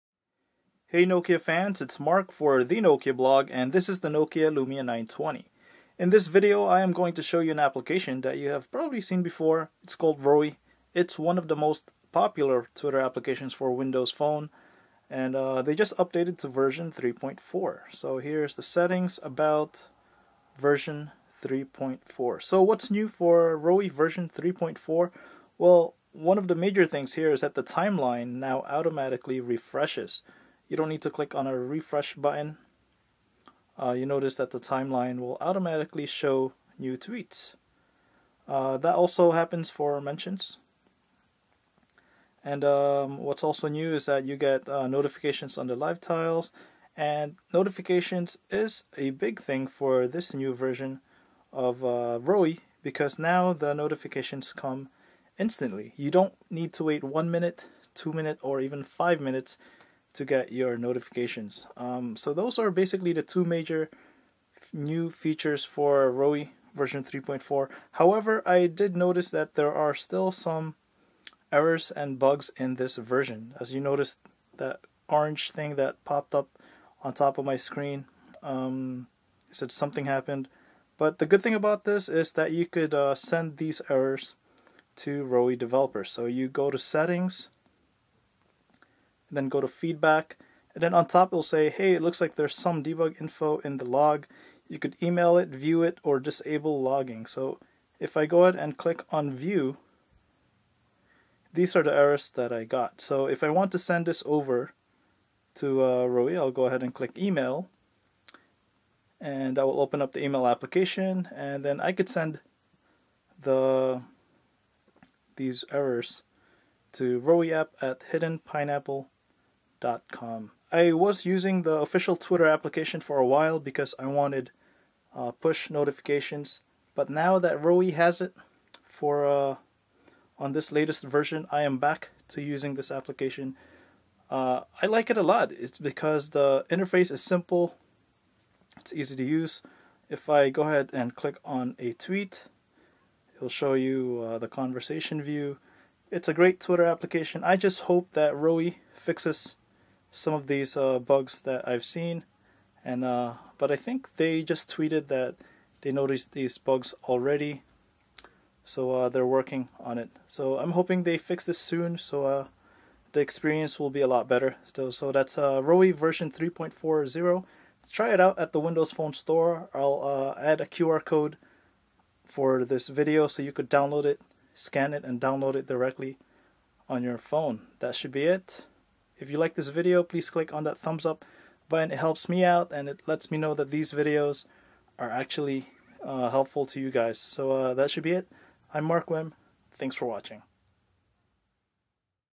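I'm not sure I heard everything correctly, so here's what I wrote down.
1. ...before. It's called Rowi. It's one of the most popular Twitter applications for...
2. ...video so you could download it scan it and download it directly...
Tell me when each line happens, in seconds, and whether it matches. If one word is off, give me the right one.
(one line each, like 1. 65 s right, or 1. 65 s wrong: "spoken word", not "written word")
1. 9 s right
2. 172 s right.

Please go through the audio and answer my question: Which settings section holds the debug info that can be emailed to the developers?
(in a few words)
feedback.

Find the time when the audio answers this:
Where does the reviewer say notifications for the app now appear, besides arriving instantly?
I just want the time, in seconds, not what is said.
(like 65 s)
45 s.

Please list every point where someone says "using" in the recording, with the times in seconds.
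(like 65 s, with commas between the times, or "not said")
121 s, 132 s.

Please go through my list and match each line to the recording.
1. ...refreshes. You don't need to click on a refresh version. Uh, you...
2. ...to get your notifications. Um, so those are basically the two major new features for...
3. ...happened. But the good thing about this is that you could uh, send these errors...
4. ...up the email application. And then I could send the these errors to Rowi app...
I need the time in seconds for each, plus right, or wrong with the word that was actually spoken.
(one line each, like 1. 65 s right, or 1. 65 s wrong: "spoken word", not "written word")
1. 29 s wrong: "button", not "version"
2. 60 s right
3. 80 s right
4. 110 s right.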